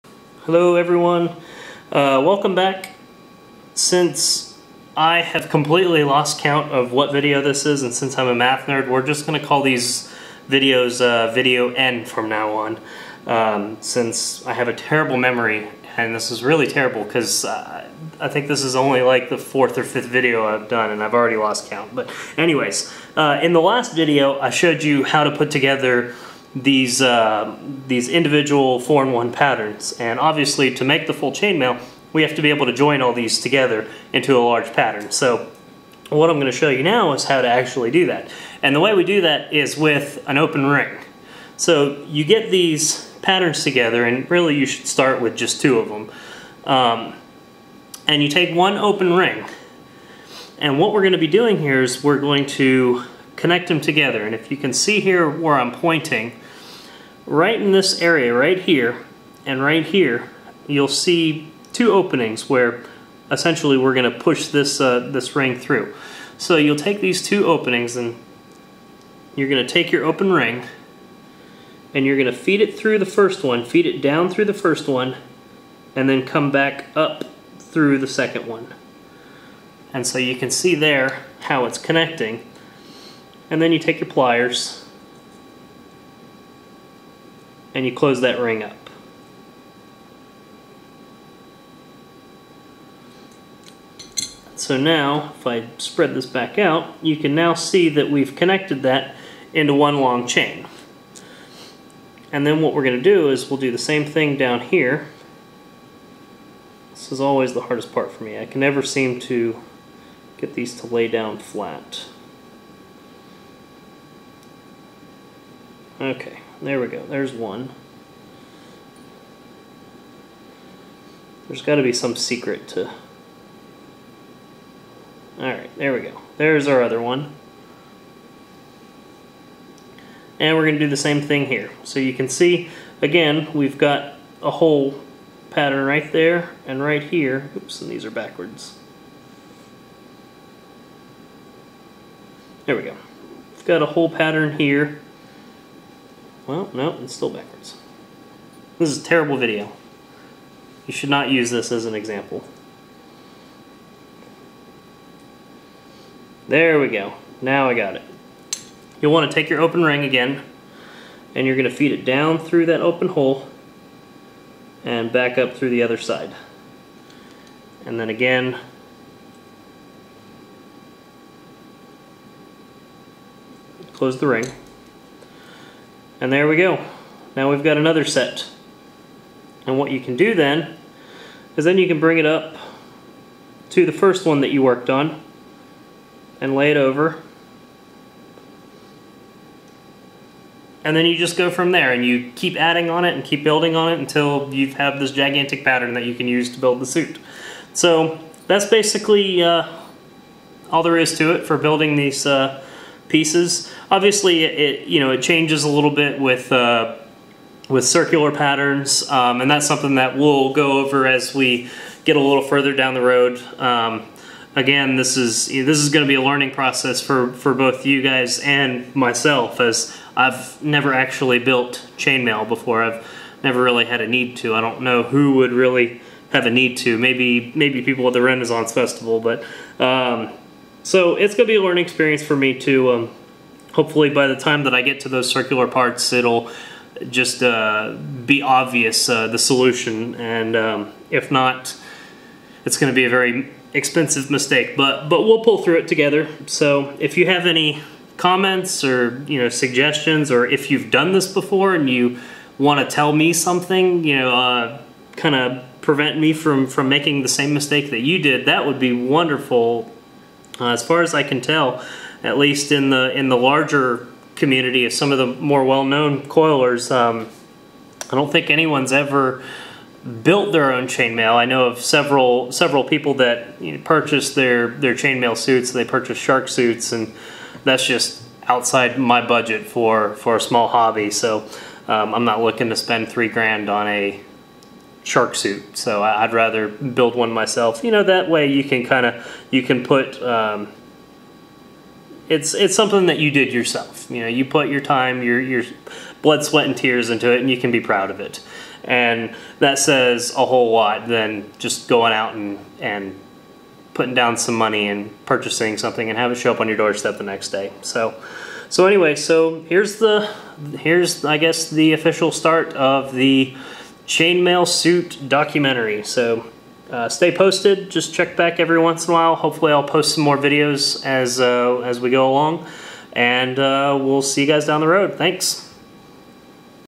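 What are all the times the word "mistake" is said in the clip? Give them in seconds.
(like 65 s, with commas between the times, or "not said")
244 s, 257 s.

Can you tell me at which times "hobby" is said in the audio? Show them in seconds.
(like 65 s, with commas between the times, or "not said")
280 s.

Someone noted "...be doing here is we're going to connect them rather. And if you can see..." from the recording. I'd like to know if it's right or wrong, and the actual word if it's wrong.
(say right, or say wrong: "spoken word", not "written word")
wrong: "together", not "rather".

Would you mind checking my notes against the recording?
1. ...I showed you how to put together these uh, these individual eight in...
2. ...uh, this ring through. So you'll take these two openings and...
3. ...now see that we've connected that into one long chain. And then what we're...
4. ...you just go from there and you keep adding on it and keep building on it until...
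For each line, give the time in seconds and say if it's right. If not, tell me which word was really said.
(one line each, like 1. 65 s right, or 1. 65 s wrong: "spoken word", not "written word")
1. 24 s wrong: "four", not "eight"
2. 64 s right
3. 97 s right
4. 191 s right.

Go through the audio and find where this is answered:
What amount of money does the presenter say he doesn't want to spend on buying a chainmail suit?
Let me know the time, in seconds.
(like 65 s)
283 s.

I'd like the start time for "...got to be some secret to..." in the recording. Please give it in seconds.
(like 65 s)
121 s.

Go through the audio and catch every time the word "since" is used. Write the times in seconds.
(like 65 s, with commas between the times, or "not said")
3 s, 7 s, 13 s.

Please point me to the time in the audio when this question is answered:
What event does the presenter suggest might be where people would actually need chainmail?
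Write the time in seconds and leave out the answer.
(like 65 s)
228 s.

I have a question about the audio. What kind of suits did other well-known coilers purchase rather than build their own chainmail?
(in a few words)
Shark suits.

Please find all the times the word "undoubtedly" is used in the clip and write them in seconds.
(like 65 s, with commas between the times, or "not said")
not said.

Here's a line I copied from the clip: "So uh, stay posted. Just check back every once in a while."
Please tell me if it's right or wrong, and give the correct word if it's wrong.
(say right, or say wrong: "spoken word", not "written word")
right.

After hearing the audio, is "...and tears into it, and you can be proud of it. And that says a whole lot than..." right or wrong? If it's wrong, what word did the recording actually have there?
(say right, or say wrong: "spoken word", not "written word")
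right.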